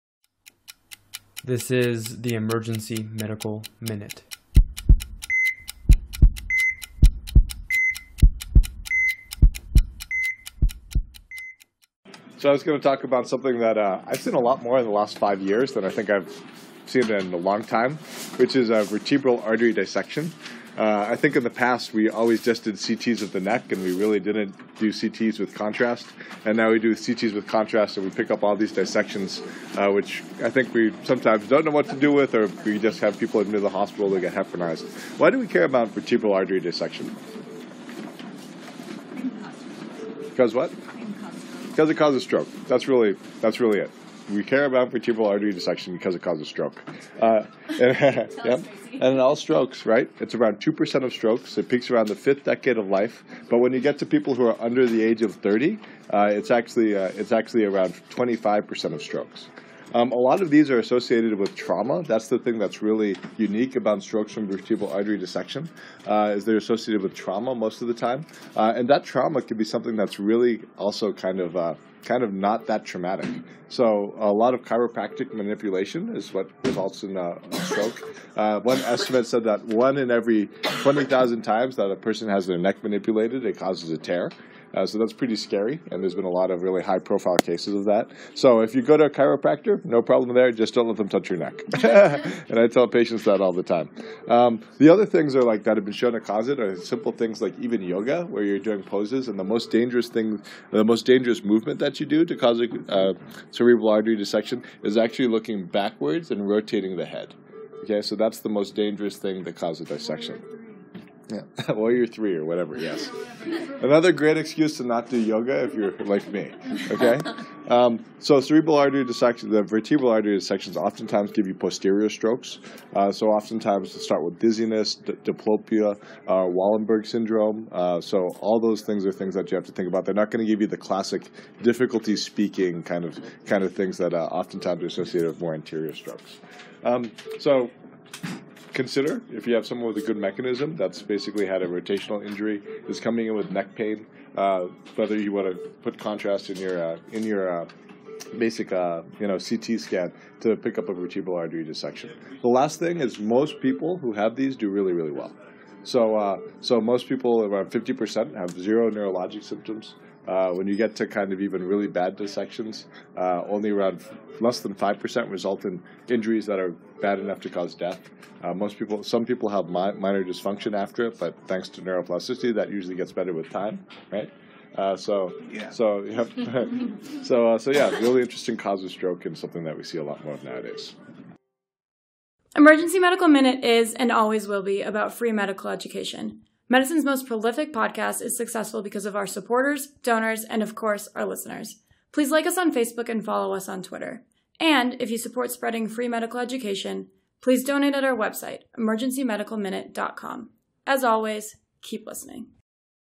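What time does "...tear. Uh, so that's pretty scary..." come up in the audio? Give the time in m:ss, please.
1:23.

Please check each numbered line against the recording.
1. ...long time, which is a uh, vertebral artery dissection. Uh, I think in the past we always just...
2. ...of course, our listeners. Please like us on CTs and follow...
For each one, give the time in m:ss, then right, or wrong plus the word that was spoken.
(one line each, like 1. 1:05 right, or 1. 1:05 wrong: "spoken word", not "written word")
1. 0:17 right
2. 3:10 wrong: "Facebook", not "CTs".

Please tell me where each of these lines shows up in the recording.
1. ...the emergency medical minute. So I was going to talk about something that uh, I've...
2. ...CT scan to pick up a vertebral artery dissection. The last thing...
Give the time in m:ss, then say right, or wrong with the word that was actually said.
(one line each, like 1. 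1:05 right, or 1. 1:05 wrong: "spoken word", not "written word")
1. 0:02 right
2. 2:29 right.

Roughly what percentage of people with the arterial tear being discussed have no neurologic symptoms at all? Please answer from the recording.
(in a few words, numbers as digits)
50%.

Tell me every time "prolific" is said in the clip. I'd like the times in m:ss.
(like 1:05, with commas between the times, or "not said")
3:07.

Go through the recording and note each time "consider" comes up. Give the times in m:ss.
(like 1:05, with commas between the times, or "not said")
2:18.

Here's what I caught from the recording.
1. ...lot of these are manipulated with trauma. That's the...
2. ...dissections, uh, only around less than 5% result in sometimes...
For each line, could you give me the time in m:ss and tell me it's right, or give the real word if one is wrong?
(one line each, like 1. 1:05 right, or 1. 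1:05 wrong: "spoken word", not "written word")
1. 1:00 wrong: "associated", not "manipulated"
2. 2:42 wrong: "injuries", not "sometimes".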